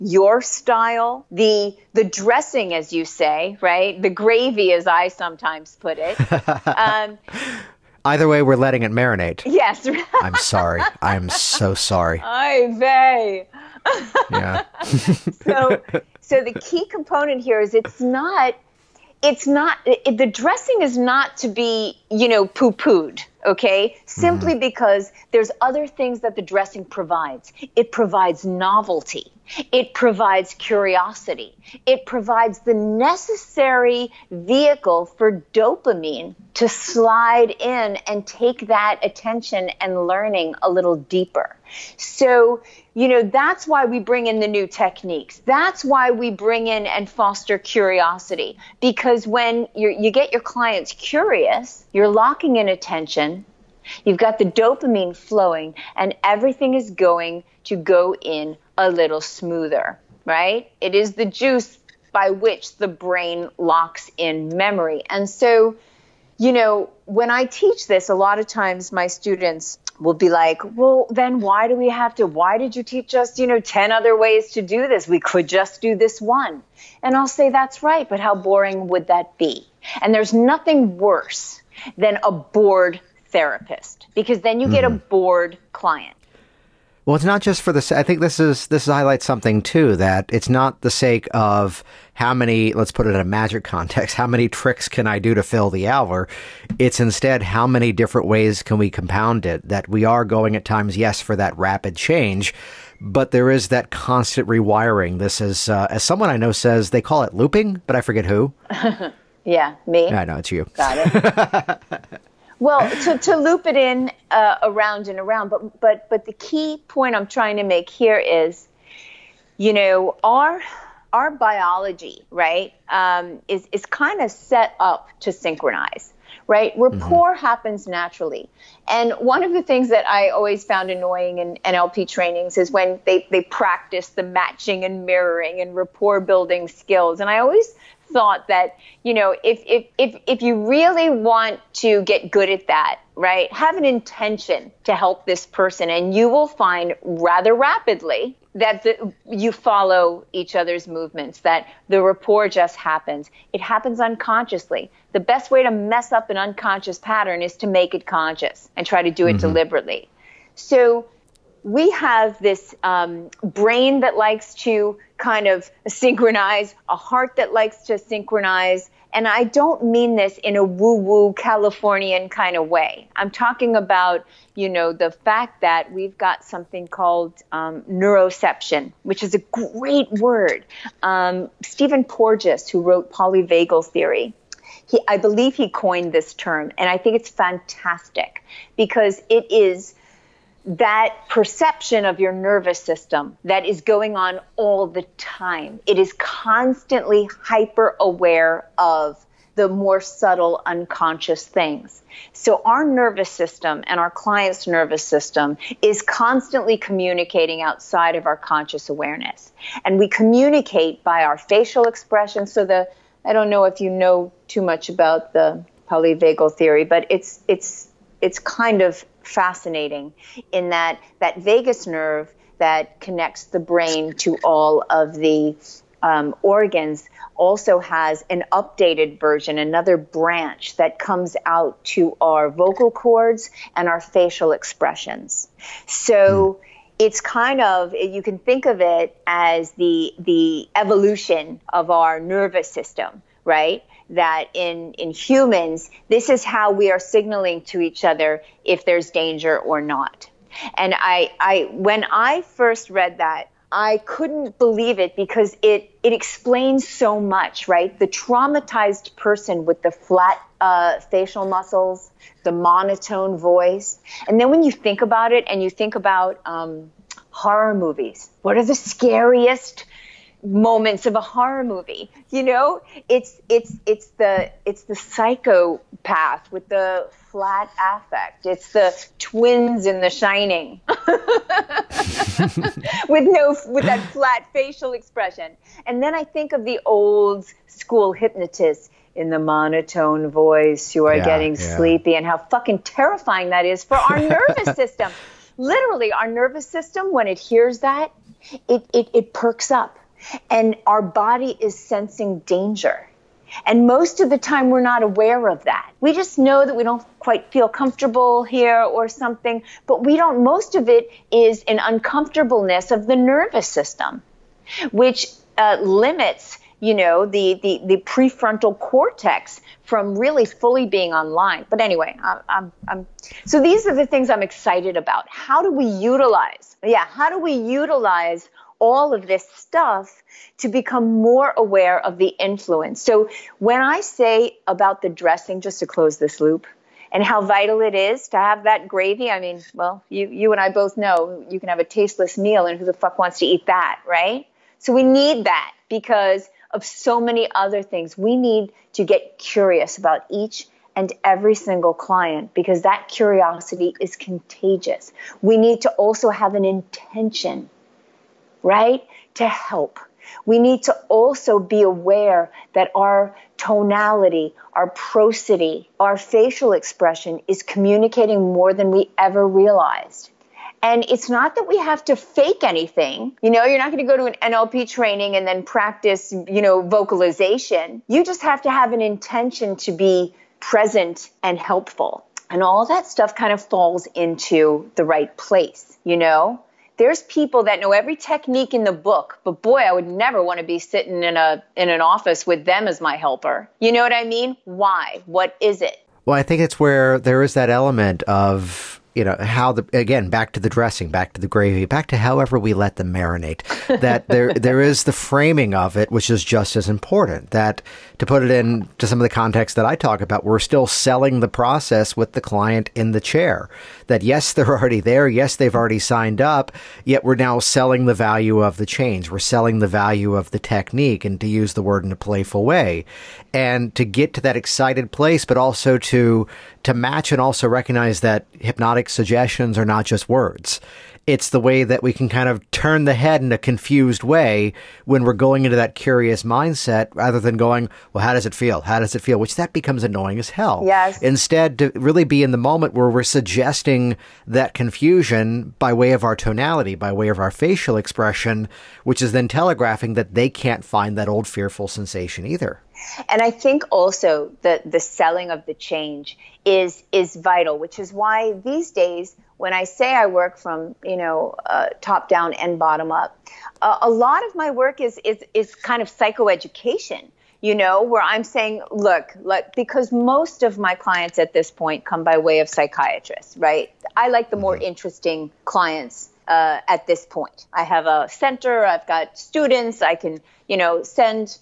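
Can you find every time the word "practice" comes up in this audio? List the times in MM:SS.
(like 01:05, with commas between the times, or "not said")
02:13, 06:15.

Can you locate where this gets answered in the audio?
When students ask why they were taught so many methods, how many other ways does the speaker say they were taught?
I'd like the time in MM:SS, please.
01:13.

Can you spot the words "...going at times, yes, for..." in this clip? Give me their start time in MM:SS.
01:40.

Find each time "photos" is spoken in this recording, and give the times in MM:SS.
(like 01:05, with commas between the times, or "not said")
not said.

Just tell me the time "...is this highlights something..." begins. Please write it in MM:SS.
01:28.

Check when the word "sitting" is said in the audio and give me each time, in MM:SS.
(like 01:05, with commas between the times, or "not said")
06:30.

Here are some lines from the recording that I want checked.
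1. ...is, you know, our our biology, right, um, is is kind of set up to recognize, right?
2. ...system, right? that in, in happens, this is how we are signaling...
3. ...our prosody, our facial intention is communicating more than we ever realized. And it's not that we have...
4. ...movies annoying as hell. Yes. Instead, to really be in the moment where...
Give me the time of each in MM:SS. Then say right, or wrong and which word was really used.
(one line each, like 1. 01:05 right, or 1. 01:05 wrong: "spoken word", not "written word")
1. 01:58 wrong: "synchronize", not "recognize"
2. 04:02 wrong: "humans", not "happens"
3. 06:04 wrong: "expression", not "intention"
4. 07:19 wrong: "becomes", not "movies".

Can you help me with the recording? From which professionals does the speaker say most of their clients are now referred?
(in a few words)
psychiatrists.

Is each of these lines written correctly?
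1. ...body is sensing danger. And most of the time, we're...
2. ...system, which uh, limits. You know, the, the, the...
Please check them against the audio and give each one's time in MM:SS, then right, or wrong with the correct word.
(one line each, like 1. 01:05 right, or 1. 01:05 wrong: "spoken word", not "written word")
1. 05:01 right
2. 05:13 right.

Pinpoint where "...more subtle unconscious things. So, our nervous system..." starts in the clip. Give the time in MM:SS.
03:19.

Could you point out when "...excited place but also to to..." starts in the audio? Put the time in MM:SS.
07:04.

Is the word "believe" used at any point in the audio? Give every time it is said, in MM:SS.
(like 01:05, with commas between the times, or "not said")
03:05, 04:14.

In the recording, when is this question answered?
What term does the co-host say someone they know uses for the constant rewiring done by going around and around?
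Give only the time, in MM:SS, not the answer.
01:47.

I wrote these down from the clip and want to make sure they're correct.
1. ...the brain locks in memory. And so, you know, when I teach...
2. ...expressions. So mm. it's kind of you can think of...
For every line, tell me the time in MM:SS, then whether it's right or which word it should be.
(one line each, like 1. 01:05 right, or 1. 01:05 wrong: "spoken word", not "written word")
1. 01:02 right
2. 03:54 right.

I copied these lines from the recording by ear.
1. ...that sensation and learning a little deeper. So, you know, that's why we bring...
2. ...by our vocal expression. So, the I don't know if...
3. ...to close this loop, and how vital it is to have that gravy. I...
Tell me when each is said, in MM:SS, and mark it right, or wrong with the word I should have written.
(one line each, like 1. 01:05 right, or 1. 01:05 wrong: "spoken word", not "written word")
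1. 00:38 wrong: "attention", not "sensation"
2. 03:31 wrong: "facial", not "vocal"
3. 05:35 right.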